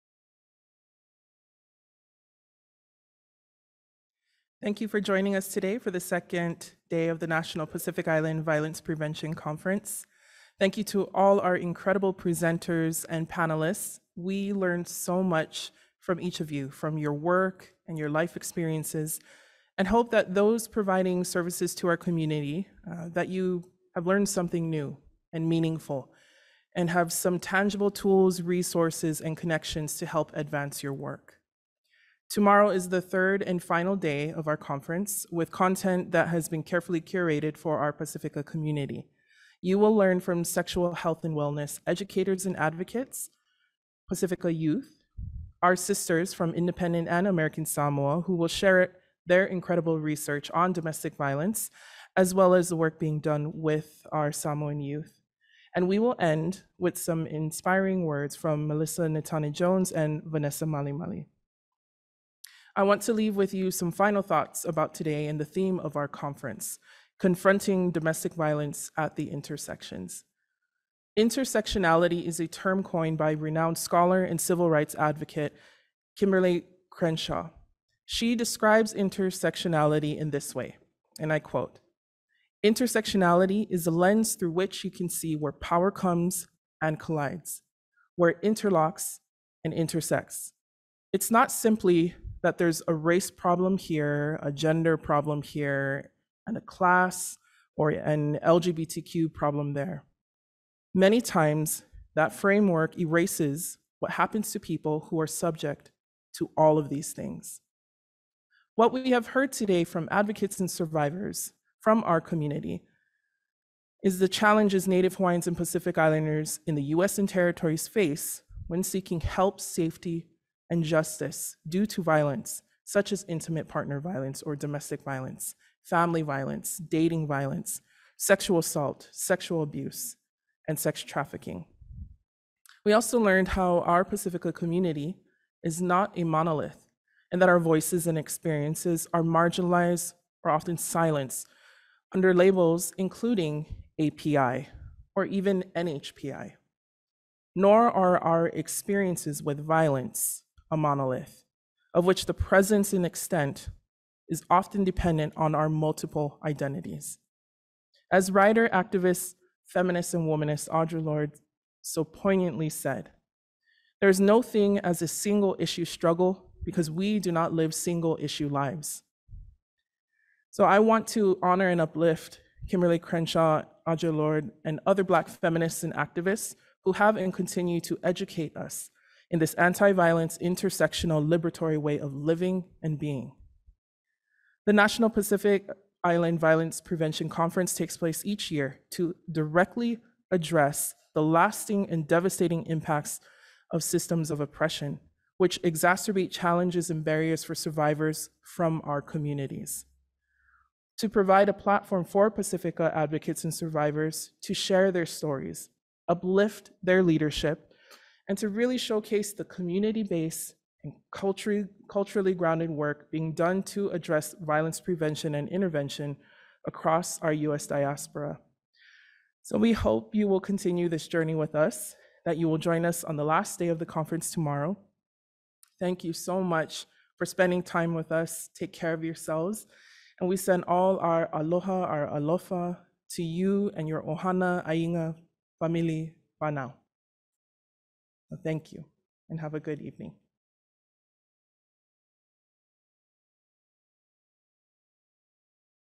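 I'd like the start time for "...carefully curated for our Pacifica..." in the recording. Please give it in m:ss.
0:36.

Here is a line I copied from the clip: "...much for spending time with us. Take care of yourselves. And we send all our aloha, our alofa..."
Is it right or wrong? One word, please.
right.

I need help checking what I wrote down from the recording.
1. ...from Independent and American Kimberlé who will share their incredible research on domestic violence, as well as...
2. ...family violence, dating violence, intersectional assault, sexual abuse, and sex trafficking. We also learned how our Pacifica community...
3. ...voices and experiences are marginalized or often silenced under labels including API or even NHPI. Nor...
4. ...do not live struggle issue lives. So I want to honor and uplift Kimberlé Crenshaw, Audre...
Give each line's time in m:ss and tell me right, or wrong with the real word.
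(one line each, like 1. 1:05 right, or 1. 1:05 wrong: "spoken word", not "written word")
1. 0:46 wrong: "Samoa", not "Kimberlé"
2. 2:05 wrong: "sexual", not "intersectional"
3. 2:17 right
4. 2:47 wrong: "single", not "struggle".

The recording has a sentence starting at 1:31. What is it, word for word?
It's not simply that there's a race problem here, a gender problem here, and a class or an LGBTQ problem there.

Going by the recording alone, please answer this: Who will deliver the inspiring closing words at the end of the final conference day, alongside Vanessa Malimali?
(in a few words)
Melissa Natani Jones.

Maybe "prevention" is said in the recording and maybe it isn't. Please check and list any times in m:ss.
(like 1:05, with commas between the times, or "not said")
0:08, 3:06, 3:34.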